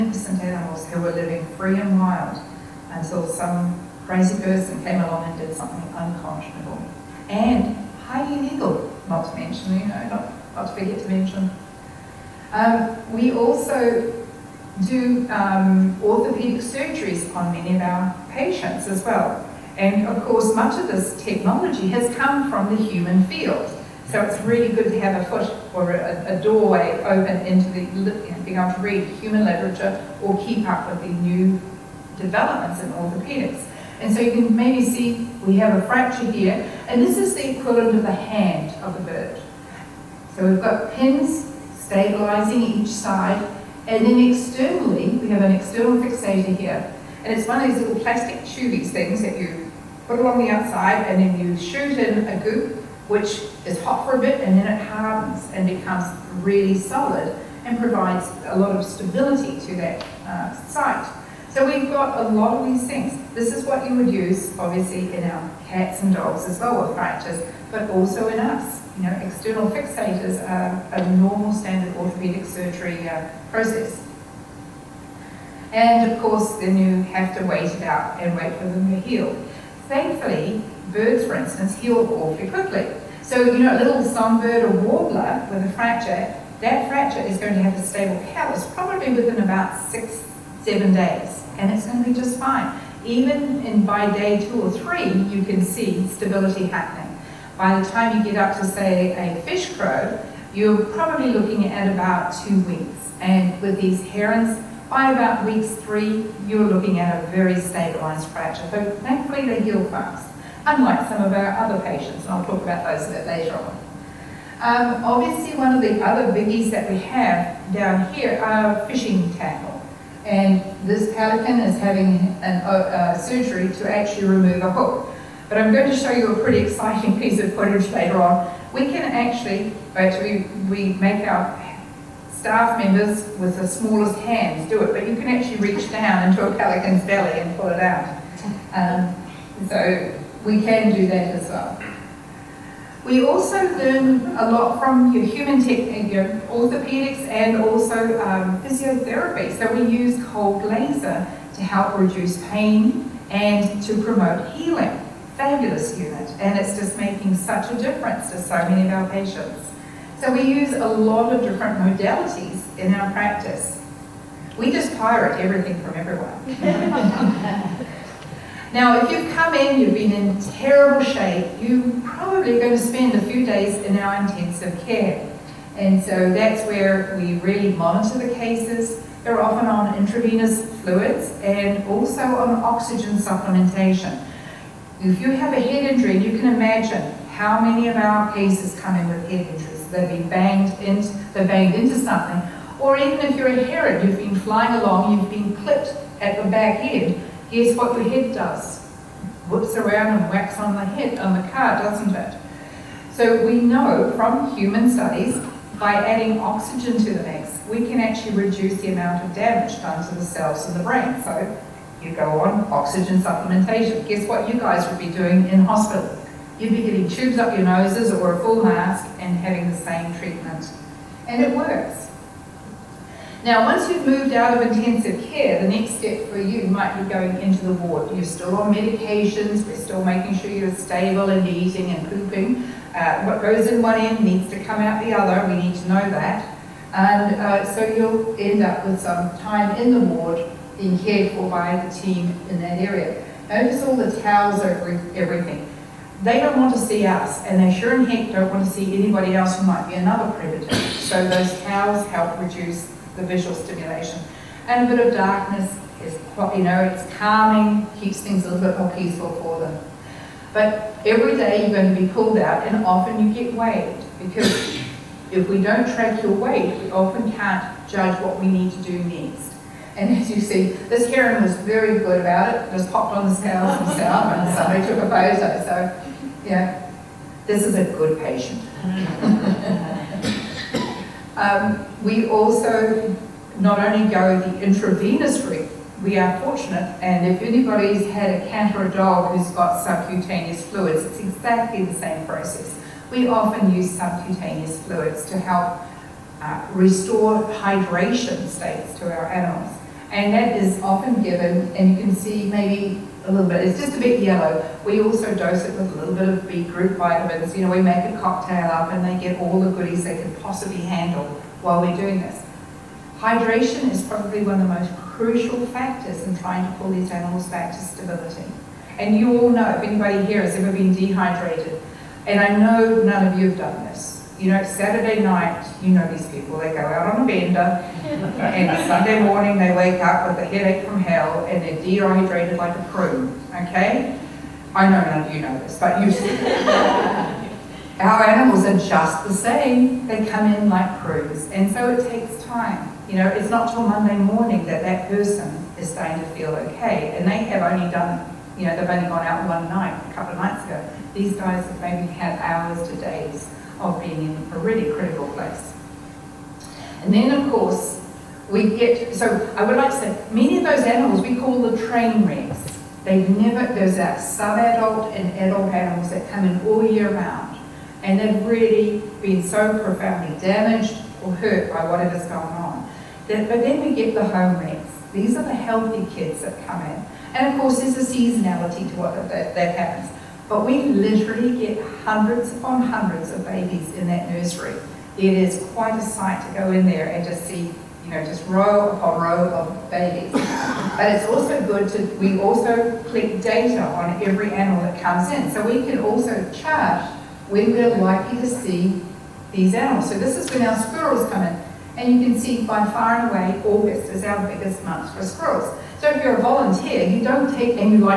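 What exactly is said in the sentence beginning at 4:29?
And as you see, this heron was very good about it, just popped on the scales himself and somebody took a photo.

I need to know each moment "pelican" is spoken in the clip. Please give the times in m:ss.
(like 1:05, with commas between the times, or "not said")
2:01, 2:16.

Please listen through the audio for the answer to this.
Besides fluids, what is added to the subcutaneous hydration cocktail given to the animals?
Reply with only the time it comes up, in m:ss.
5:06.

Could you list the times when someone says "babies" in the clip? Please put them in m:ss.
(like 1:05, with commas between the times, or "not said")
6:23, 6:29.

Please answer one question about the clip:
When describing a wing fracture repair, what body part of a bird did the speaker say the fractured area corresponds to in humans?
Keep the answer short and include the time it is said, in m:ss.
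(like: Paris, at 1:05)
hand, at 0:38.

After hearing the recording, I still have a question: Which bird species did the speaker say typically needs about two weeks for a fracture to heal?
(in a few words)
fish crow.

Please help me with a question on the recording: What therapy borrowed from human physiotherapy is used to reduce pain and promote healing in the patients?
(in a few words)
cold laser.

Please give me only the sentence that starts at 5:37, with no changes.
Our animals are just the same.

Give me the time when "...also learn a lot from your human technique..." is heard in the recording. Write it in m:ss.
2:23.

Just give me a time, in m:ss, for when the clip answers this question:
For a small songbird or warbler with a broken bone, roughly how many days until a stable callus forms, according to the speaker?
1:29.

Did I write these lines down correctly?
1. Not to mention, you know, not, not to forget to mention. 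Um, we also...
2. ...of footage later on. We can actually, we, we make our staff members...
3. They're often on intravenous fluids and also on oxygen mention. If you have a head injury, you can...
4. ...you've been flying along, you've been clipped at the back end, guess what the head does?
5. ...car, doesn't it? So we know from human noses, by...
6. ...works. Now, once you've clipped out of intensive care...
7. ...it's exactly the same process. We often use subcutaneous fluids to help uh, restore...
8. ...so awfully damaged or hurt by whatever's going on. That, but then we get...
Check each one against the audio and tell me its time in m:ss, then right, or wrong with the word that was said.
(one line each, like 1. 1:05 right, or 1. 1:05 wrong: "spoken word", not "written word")
1. 0:09 right
2. 2:07 right
3. 2:59 wrong: "supplementation", not "mention"
4. 3:14 right
5. 3:21 wrong: "studies", not "noses"
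6. 3:41 wrong: "moved", not "clipped"
7. 4:51 right
8. 6:09 wrong: "profoundly", not "awfully".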